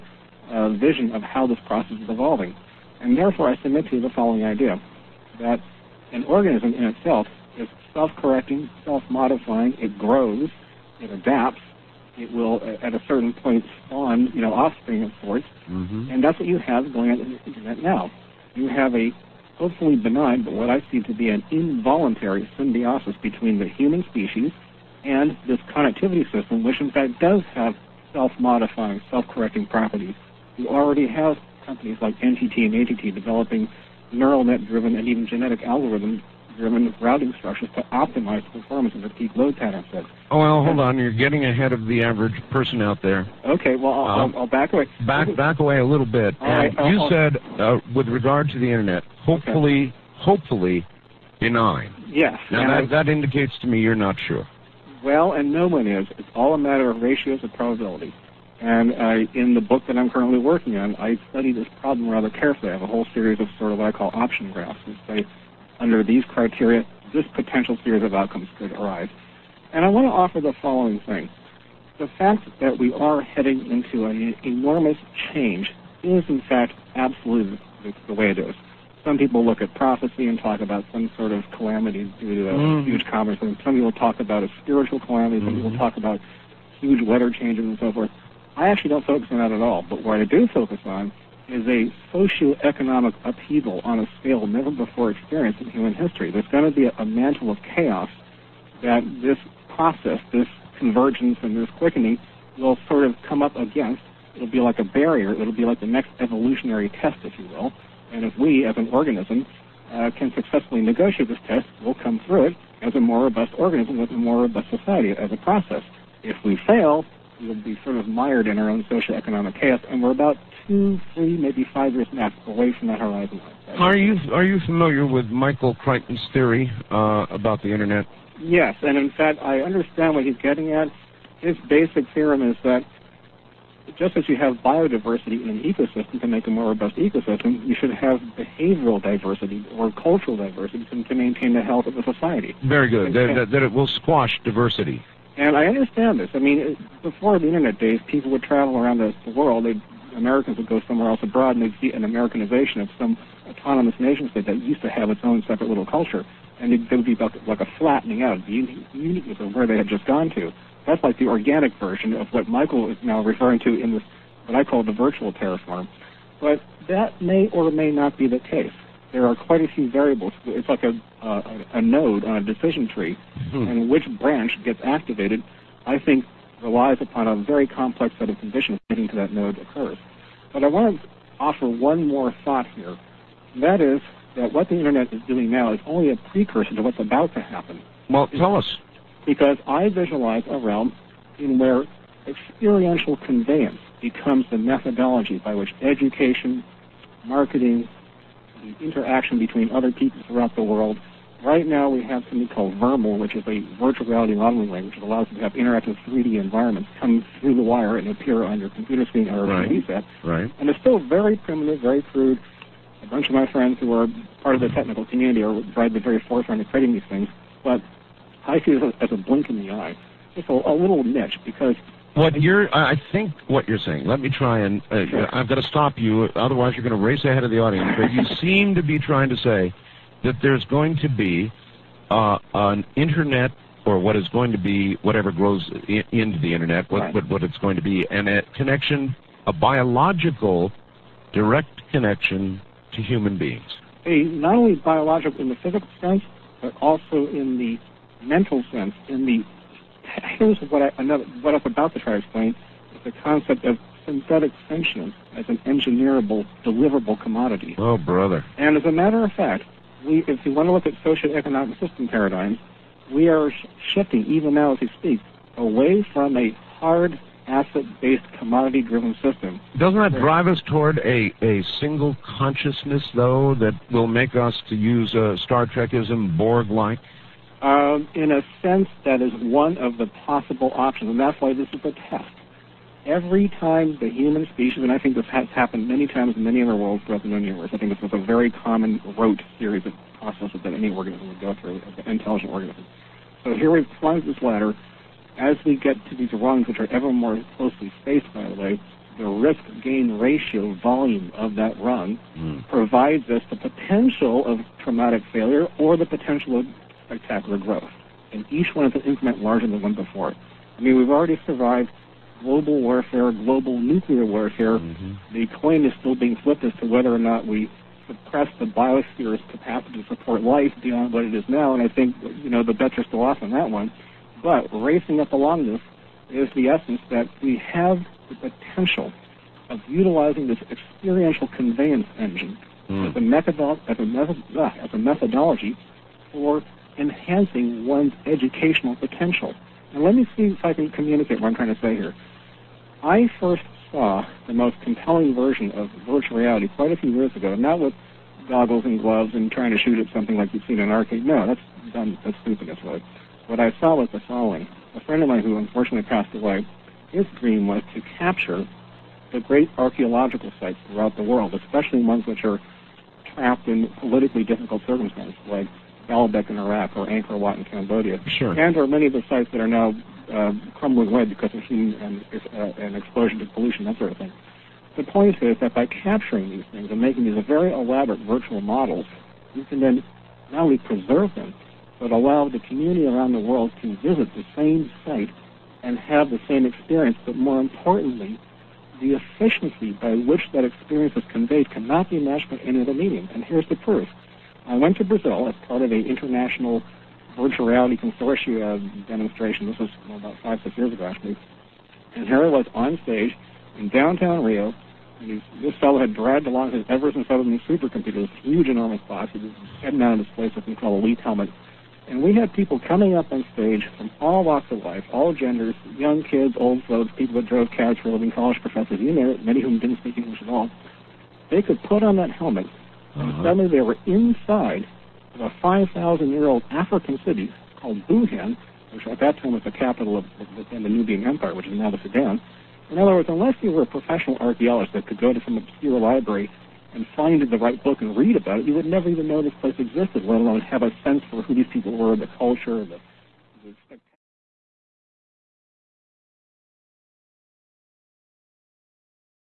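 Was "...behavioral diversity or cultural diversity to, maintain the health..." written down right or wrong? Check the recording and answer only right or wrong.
right.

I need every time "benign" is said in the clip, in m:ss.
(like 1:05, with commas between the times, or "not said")
0:19, 0:51.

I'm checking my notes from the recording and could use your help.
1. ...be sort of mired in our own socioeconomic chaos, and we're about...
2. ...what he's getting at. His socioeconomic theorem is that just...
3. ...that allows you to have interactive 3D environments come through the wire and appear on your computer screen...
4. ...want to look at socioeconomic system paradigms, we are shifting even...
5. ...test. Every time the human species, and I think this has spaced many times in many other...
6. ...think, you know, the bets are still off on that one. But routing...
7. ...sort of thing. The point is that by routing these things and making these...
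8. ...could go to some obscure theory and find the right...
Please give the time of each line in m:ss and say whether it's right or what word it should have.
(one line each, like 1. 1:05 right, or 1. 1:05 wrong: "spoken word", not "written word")
1. 1:57 right
2. 2:10 wrong: "basic", not "socioeconomic"
3. 3:24 right
4. 4:20 right
5. 4:42 wrong: "happened", not "spaced"
6. 5:21 wrong: "racing", not "routing"
7. 6:13 wrong: "capturing", not "routing"
8. 7:15 wrong: "library", not "theory".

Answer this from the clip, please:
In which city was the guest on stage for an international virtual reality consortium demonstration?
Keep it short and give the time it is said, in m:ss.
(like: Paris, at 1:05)
Rio, at 6:44.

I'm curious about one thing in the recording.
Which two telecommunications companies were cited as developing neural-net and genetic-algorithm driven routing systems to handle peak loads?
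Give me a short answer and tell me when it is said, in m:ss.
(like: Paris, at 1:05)
NTT and AT&T, at 0:32.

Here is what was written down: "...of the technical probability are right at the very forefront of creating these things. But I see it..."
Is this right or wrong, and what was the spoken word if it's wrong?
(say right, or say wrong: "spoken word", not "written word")
wrong: "community", not "probability".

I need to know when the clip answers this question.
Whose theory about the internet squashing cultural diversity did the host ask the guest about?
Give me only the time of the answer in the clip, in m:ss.
2:05.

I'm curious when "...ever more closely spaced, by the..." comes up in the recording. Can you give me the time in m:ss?
4:56.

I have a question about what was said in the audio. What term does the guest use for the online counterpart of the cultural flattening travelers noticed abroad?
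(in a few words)
virtual terraform.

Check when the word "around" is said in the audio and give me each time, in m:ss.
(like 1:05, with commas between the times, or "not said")
2:28, 6:23.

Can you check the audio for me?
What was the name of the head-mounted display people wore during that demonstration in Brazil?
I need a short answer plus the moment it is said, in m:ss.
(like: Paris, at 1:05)
Elite Helmet, at 6:51.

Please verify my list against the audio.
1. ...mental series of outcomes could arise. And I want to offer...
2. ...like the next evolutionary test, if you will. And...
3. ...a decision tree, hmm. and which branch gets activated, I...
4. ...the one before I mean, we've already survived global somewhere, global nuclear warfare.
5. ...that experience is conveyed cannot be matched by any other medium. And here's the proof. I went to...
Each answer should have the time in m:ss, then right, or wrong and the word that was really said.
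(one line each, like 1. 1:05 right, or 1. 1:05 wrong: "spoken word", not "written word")
1. 1:07 wrong: "potential", not "mental"
2. 1:45 right
3. 2:52 right
4. 5:09 wrong: "warfare", not "somewhere"
5. 6:30 right.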